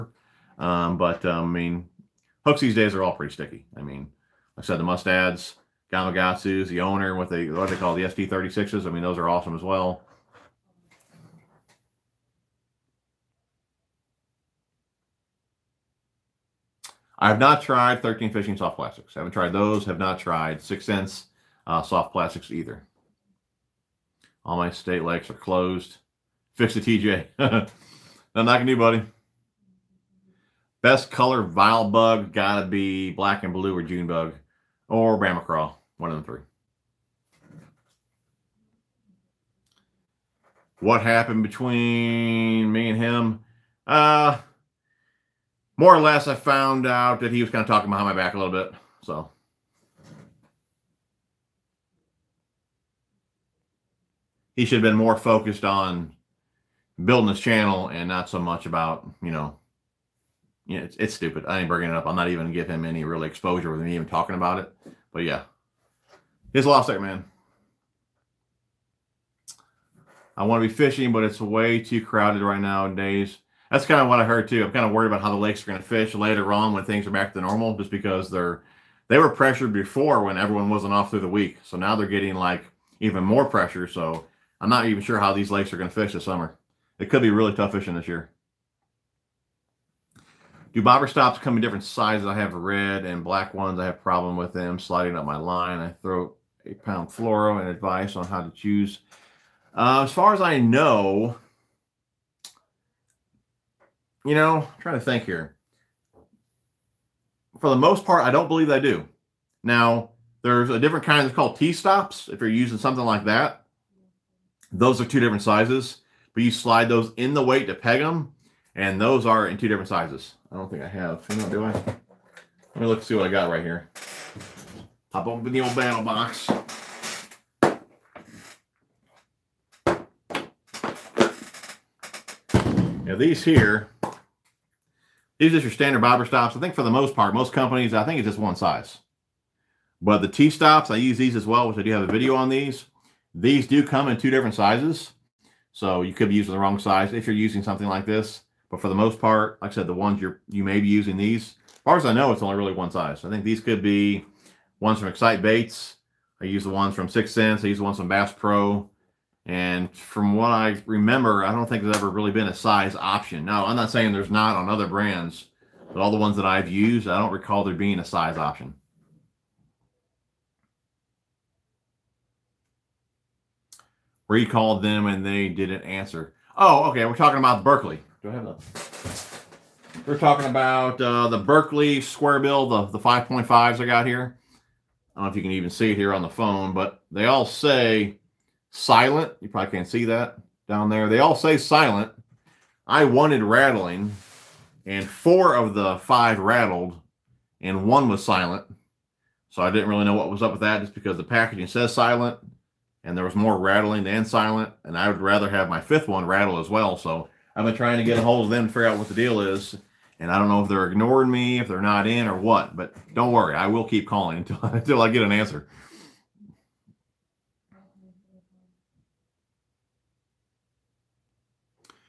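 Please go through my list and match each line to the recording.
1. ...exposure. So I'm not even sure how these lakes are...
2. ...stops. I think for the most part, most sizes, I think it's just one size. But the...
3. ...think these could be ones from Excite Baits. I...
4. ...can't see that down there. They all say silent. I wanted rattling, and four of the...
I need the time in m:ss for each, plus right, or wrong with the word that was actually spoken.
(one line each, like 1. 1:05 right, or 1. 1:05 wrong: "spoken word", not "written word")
1. 1:23 wrong: "pressure", not "exposure"
2. 2:16 wrong: "companies", not "sizes"
3. 2:33 right
4. 3:09 right.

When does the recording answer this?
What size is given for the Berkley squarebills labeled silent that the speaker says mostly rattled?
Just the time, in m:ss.
3:02.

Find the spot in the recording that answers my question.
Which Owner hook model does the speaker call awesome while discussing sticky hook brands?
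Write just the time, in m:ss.
0:08.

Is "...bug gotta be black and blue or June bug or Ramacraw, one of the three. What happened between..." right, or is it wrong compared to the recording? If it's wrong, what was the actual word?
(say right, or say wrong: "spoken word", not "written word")
right.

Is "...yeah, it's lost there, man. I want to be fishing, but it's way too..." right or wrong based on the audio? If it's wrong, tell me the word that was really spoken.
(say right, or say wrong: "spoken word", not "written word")
right.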